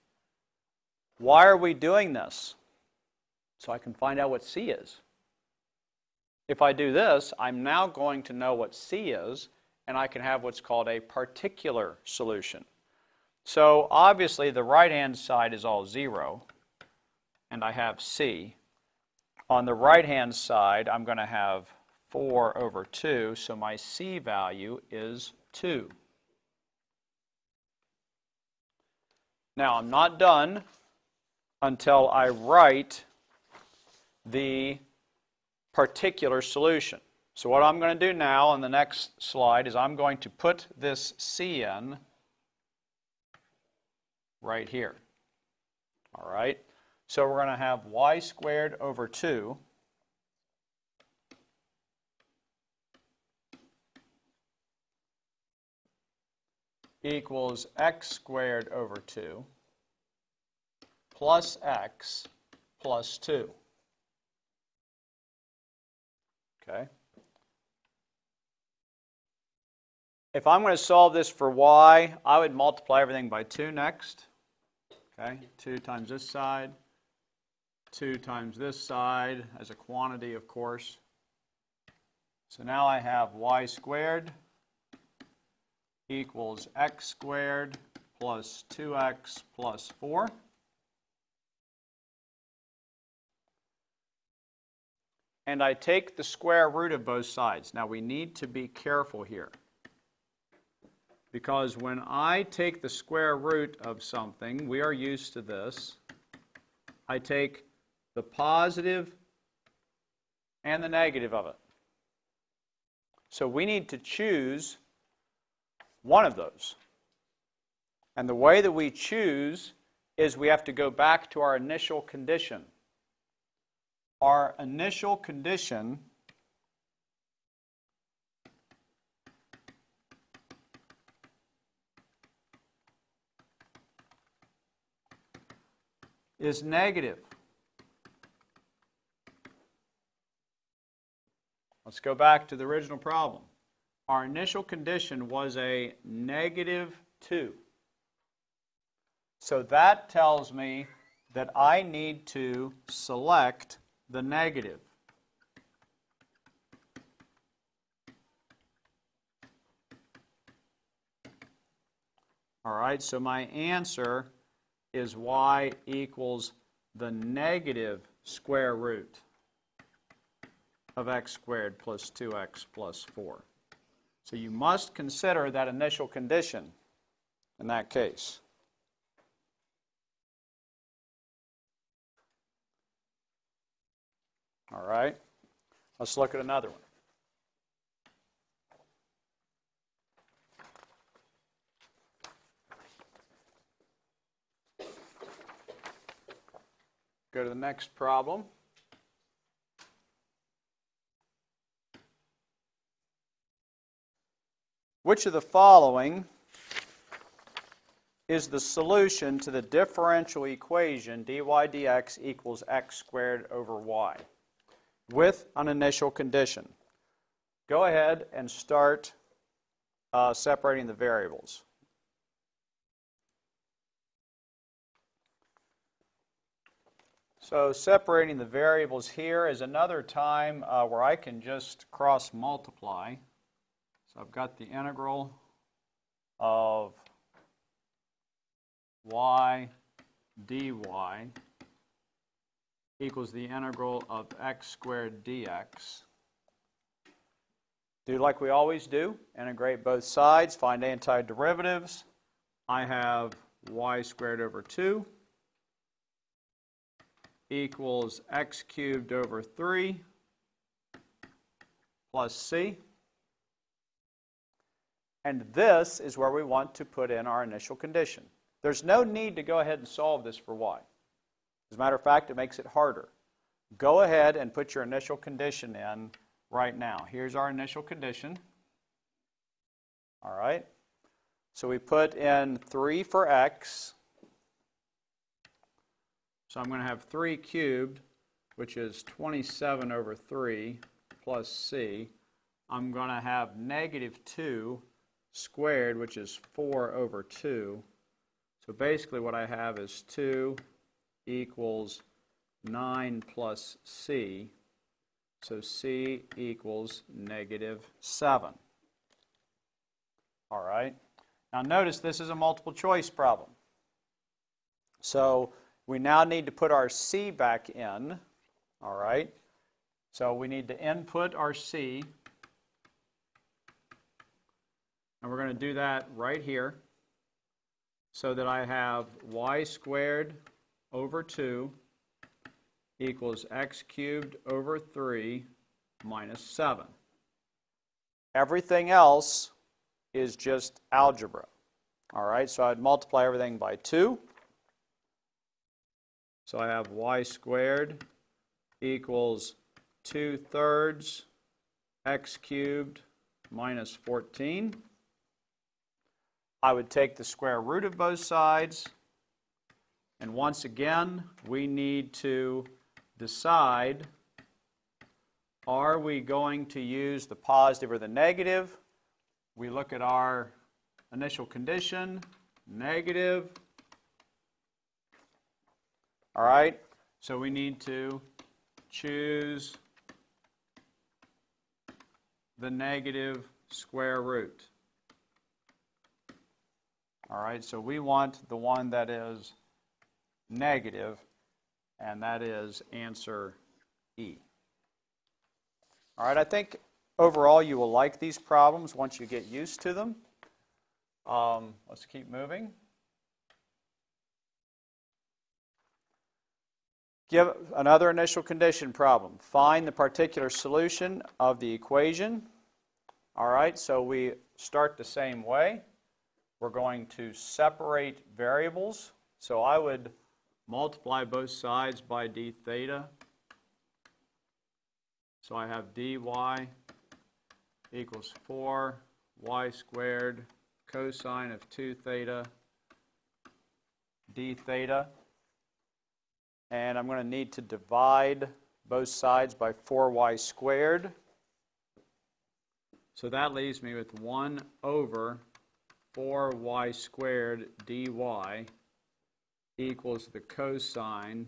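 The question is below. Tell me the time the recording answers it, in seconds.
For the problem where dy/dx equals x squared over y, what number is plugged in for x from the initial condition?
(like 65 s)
281 s.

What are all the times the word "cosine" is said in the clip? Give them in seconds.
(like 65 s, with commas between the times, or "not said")
430 s, 450 s.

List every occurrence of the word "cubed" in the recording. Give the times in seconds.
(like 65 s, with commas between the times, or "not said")
258 s, 287 s, 333 s, 352 s.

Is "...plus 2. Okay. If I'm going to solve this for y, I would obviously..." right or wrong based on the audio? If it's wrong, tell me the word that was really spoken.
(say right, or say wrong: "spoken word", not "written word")
wrong: "multiply", not "obviously".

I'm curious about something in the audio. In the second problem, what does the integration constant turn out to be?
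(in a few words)
-7.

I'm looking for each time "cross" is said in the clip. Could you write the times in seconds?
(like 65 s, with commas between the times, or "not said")
231 s.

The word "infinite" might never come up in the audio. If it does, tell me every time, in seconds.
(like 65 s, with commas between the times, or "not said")
not said.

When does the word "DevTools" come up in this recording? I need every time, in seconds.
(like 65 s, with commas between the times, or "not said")
not said.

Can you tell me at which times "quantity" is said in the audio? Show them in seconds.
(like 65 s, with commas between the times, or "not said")
79 s.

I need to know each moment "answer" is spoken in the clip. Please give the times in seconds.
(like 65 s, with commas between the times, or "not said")
163 s, 392 s.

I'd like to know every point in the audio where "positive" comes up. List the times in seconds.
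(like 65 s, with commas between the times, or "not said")
108 s, 367 s.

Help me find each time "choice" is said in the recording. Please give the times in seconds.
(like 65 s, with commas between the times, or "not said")
312 s.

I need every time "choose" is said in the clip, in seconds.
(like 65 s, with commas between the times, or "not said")
113 s, 118 s, 378 s.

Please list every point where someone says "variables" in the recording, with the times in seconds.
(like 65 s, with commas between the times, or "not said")
220 s, 228 s, 418 s.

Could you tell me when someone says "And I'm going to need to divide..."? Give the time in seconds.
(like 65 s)
436 s.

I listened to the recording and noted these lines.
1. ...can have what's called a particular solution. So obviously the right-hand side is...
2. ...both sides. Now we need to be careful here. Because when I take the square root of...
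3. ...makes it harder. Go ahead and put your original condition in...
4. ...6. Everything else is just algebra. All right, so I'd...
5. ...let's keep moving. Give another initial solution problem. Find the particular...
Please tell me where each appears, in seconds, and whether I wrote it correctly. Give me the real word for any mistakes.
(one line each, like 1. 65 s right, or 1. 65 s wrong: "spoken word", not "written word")
1. 10 s right
2. 97 s right
3. 272 s wrong: "initial", not "original"
4. 336 s wrong: "7", not "6"
5. 401 s wrong: "condition", not "solution".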